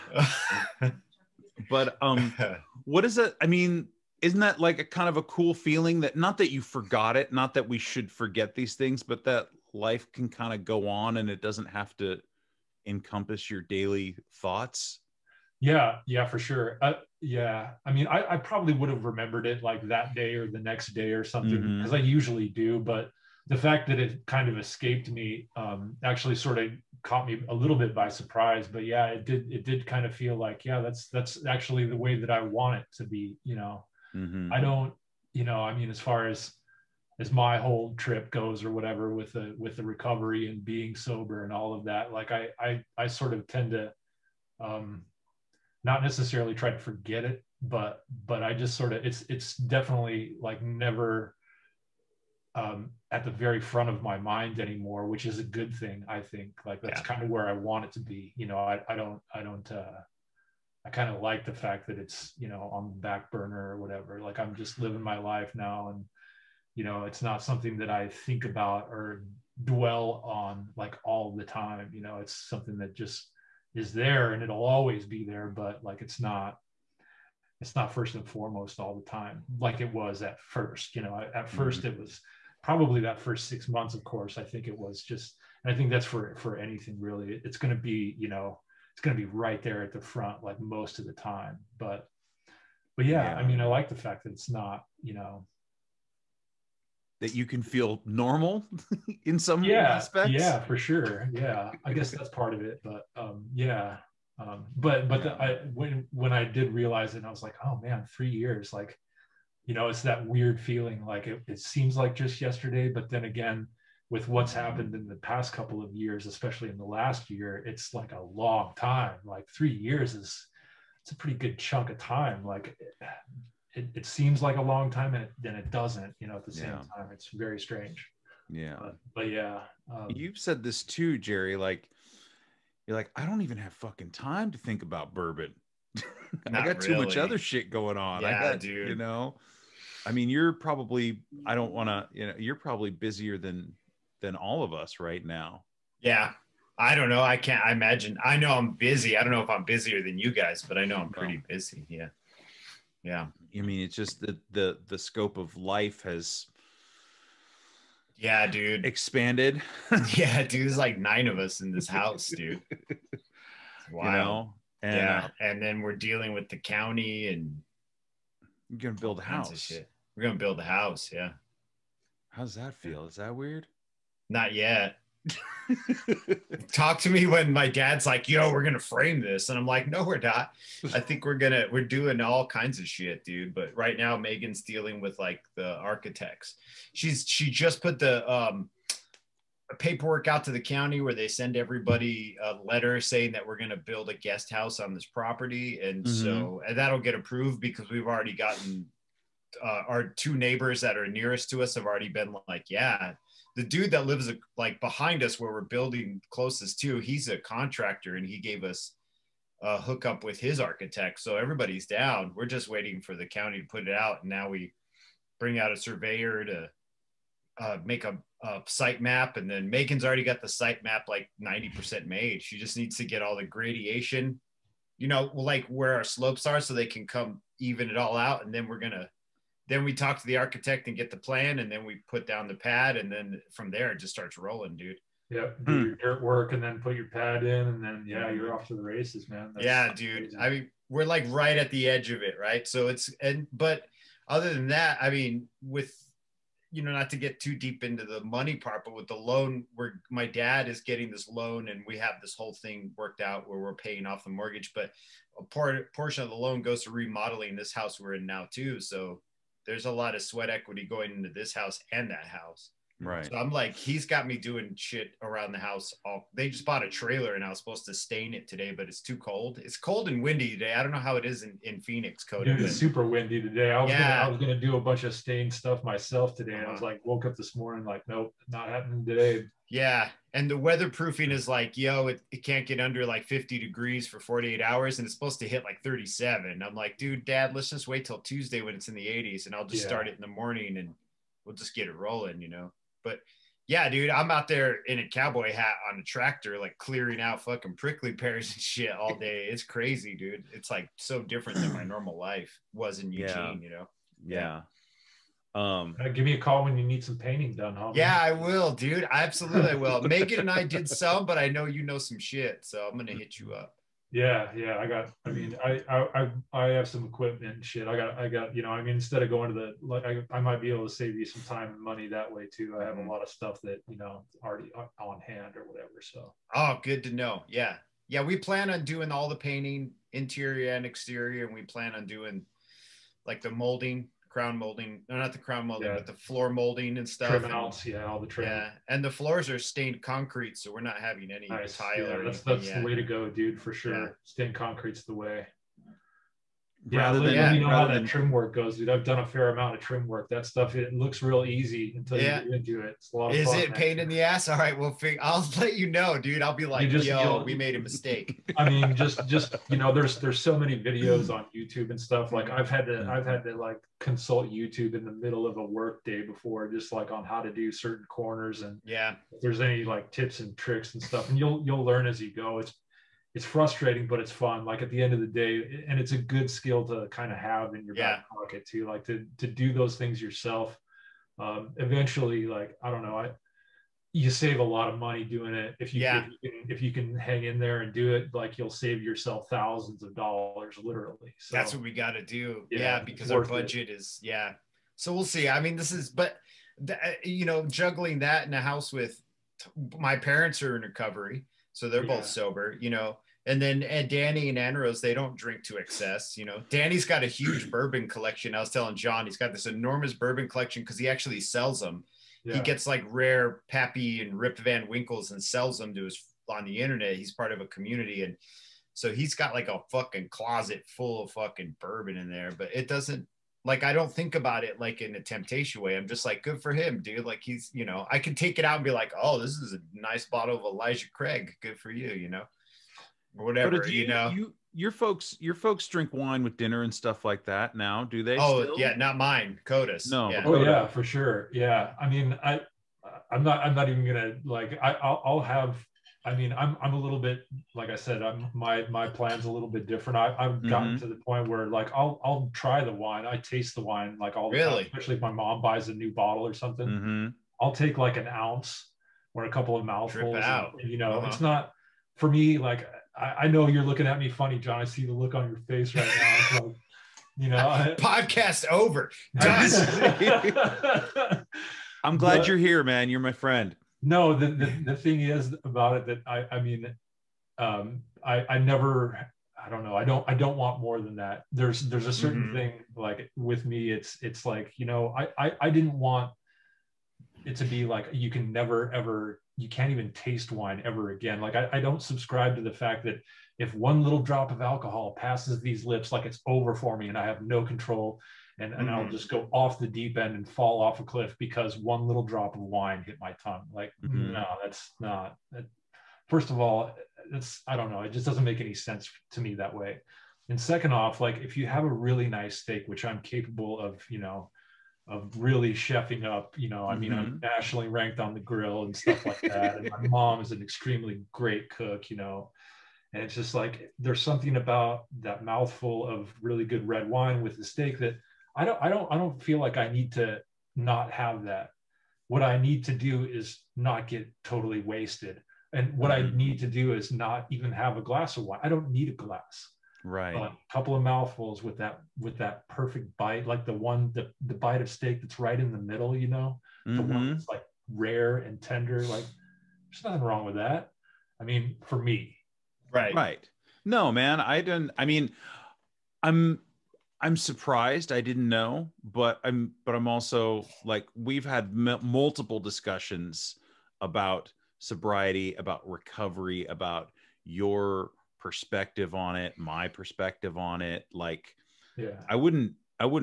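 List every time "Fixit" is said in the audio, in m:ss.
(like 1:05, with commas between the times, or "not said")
not said.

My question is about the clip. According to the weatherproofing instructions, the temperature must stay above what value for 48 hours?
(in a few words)
50 degrees.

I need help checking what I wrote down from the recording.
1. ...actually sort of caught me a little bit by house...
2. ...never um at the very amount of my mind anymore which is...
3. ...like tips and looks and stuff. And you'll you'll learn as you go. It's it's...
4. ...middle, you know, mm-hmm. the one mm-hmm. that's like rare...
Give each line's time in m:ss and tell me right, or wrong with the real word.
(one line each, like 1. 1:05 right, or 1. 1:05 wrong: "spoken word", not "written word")
1. 0:26 wrong: "surprise", not "house"
2. 0:50 wrong: "front", not "amount"
3. 6:09 wrong: "tricks", not "looks"
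4. 9:05 right.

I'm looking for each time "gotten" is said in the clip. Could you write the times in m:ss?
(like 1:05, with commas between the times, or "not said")
3:18, 7:30.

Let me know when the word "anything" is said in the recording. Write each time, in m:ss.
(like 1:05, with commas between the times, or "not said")
1:26.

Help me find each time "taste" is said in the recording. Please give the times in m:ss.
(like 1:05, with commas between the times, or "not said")
7:33, 8:10.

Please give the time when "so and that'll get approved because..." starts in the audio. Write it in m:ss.
3:16.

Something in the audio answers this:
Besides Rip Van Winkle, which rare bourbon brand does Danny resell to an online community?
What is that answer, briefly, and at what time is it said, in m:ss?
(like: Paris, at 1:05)
Pappy, at 6:53.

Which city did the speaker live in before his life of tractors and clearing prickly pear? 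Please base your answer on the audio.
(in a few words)
Eugene.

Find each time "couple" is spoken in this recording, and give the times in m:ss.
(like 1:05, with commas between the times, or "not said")
1:55, 7:39, 9:00.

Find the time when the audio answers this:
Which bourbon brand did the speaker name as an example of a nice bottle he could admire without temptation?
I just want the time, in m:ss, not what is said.
7:10.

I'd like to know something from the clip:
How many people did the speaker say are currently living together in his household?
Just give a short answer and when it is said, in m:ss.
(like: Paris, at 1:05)
9, at 2:40.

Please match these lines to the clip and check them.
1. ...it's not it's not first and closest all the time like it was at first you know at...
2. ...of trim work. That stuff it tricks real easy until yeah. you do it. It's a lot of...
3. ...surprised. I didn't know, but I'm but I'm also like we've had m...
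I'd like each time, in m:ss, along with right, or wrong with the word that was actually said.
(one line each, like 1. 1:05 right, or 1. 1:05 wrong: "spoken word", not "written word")
1. 1:16 wrong: "foremost", not "closest"
2. 5:49 wrong: "looks", not "tricks"
3. 9:17 right.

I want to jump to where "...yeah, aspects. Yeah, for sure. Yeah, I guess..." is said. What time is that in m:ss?
1:39.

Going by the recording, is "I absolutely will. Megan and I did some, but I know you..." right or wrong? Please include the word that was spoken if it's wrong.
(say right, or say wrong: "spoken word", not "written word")
right.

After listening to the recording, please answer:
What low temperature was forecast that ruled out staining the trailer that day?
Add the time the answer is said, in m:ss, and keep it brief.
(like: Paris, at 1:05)
37, at 4:45.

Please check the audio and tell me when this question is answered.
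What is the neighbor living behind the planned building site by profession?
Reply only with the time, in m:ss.
3:27.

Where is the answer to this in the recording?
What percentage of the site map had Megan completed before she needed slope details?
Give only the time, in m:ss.
3:41.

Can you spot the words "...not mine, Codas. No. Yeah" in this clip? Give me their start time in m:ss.
7:18.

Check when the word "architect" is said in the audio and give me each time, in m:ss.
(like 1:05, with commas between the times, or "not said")
3:05, 3:30, 3:50.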